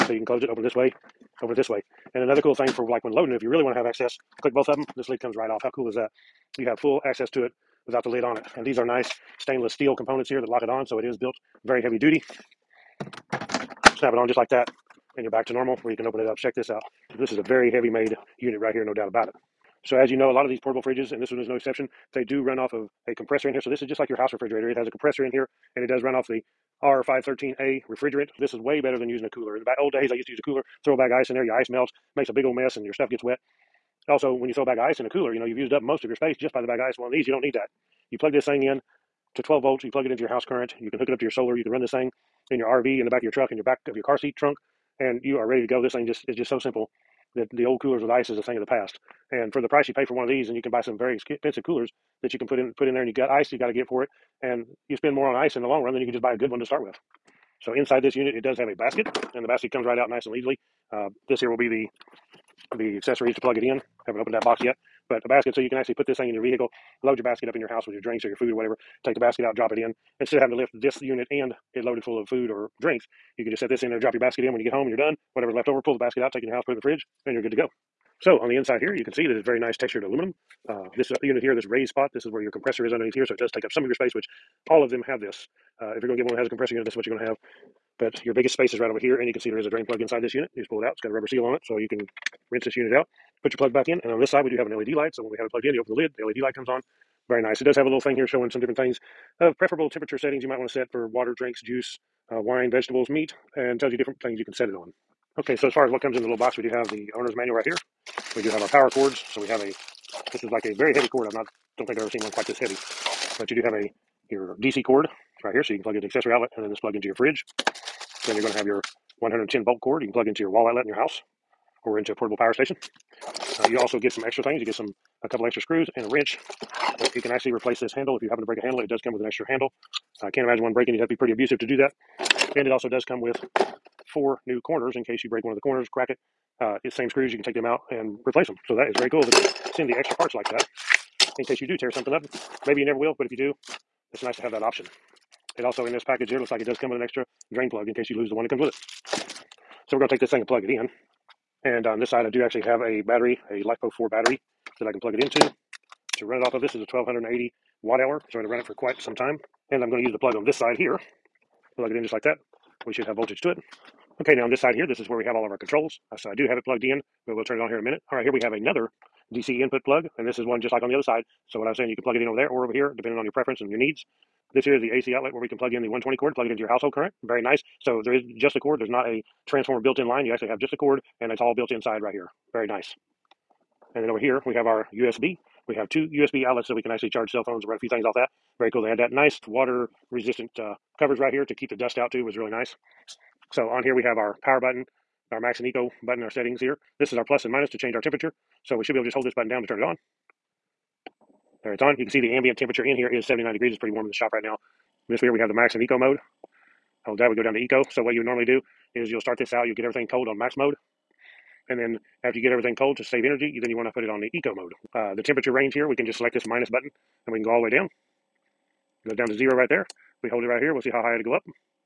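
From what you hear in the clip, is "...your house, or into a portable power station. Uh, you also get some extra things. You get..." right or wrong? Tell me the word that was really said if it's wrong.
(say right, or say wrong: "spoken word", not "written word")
right.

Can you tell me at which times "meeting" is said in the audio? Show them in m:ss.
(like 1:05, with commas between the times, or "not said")
not said.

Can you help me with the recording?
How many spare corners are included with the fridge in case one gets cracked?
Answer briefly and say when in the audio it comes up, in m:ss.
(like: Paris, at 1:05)
4, at 2:14.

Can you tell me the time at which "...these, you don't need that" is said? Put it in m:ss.
0:37.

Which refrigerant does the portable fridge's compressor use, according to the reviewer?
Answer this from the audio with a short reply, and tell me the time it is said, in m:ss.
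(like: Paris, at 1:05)
R513A, at 0:26.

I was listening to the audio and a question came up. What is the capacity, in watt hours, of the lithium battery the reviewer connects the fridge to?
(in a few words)
1280.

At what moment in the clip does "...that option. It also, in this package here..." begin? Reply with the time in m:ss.
2:24.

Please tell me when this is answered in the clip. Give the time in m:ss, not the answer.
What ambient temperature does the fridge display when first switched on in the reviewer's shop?
3:23.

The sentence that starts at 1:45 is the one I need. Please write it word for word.
Okay, so as far as what comes in the little box, we do have the owner's manual right here.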